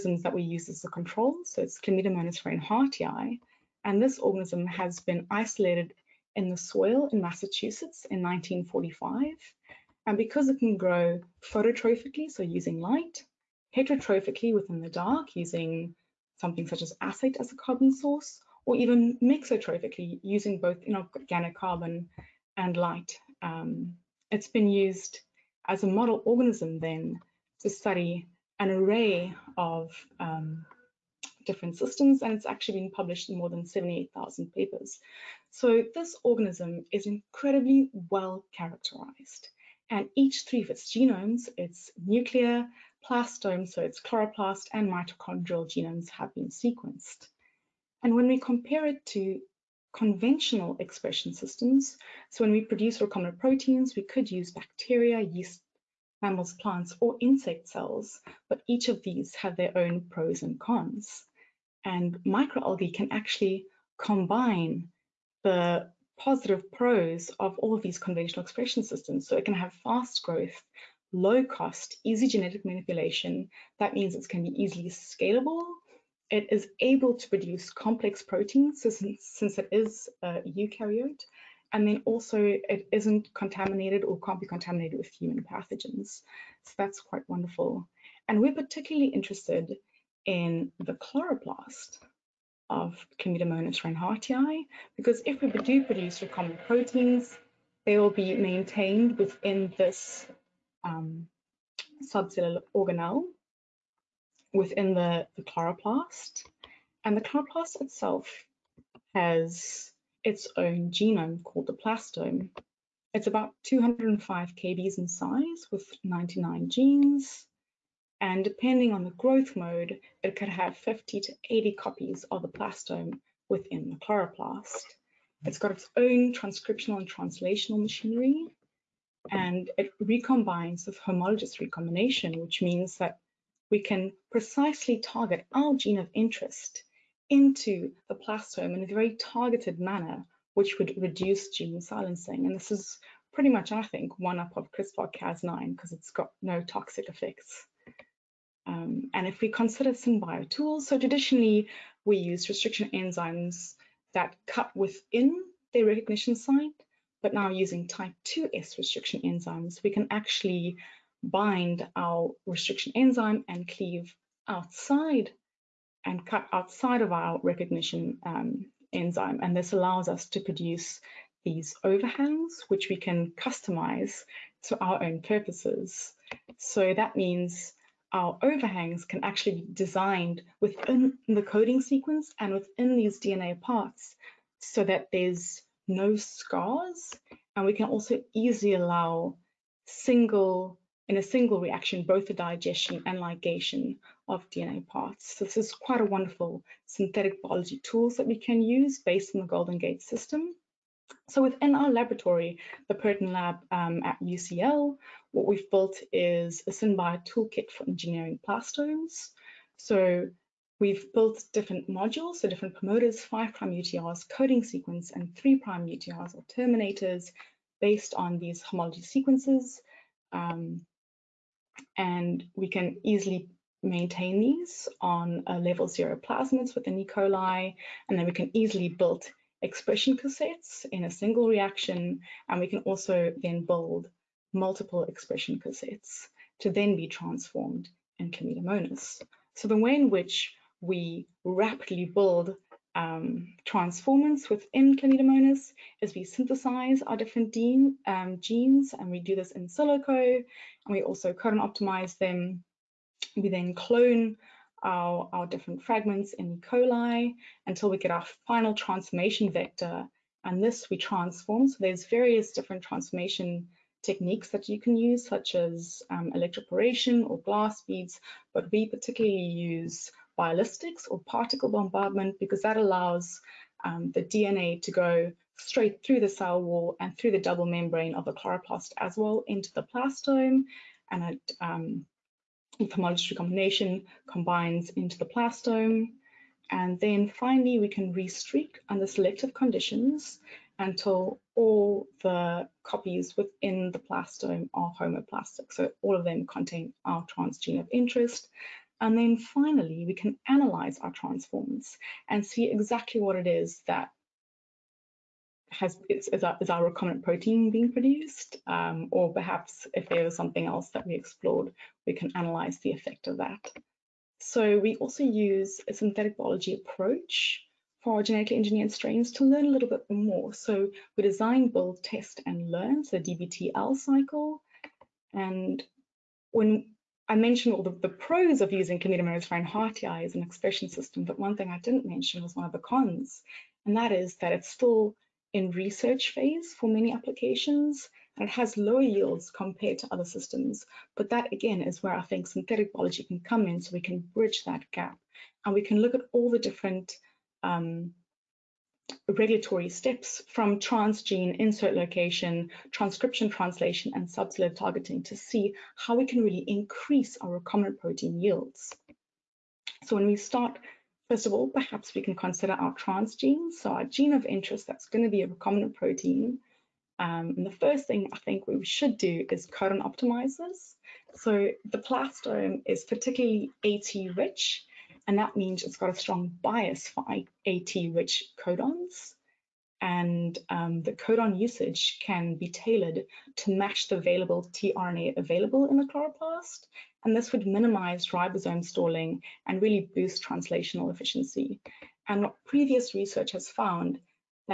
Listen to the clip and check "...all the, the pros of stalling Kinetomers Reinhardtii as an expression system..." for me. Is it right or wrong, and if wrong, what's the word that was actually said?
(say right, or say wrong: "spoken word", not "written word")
wrong: "using", not "stalling".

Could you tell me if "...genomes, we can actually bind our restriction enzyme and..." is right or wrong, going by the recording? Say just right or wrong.
wrong.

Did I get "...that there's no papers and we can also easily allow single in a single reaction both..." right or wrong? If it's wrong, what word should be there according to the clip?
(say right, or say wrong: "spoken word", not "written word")
wrong: "scars", not "papers".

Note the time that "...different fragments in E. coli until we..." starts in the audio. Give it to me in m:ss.
4:15.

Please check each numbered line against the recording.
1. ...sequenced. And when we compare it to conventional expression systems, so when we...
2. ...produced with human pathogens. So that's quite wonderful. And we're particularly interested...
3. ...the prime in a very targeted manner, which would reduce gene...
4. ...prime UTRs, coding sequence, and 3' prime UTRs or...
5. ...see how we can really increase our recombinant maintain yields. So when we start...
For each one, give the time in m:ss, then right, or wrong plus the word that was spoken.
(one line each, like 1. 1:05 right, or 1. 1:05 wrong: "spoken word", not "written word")
1. 0:46 right
2. 1:24 wrong: "contaminated", not "produced"
3. 2:18 wrong: "plastome", not "prime"
4. 3:33 right
5. 5:55 wrong: "protein", not "maintain".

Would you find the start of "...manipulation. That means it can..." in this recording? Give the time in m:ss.
1:12.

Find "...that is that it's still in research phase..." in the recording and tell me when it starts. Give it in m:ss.
5:33.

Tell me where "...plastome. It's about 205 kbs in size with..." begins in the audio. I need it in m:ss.
1:51.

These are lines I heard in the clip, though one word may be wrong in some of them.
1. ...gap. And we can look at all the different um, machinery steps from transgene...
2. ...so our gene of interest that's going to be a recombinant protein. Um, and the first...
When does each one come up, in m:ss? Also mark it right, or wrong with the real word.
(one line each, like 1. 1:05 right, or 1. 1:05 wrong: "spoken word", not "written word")
1. 5:44 wrong: "regulatory", not "machinery"
2. 6:03 right.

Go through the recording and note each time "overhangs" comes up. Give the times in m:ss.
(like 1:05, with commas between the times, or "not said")
2:51, 2:58.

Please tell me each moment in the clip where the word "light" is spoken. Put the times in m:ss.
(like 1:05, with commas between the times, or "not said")
0:12, 0:22.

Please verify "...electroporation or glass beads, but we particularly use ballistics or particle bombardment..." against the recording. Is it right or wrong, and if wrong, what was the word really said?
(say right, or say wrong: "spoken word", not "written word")
right.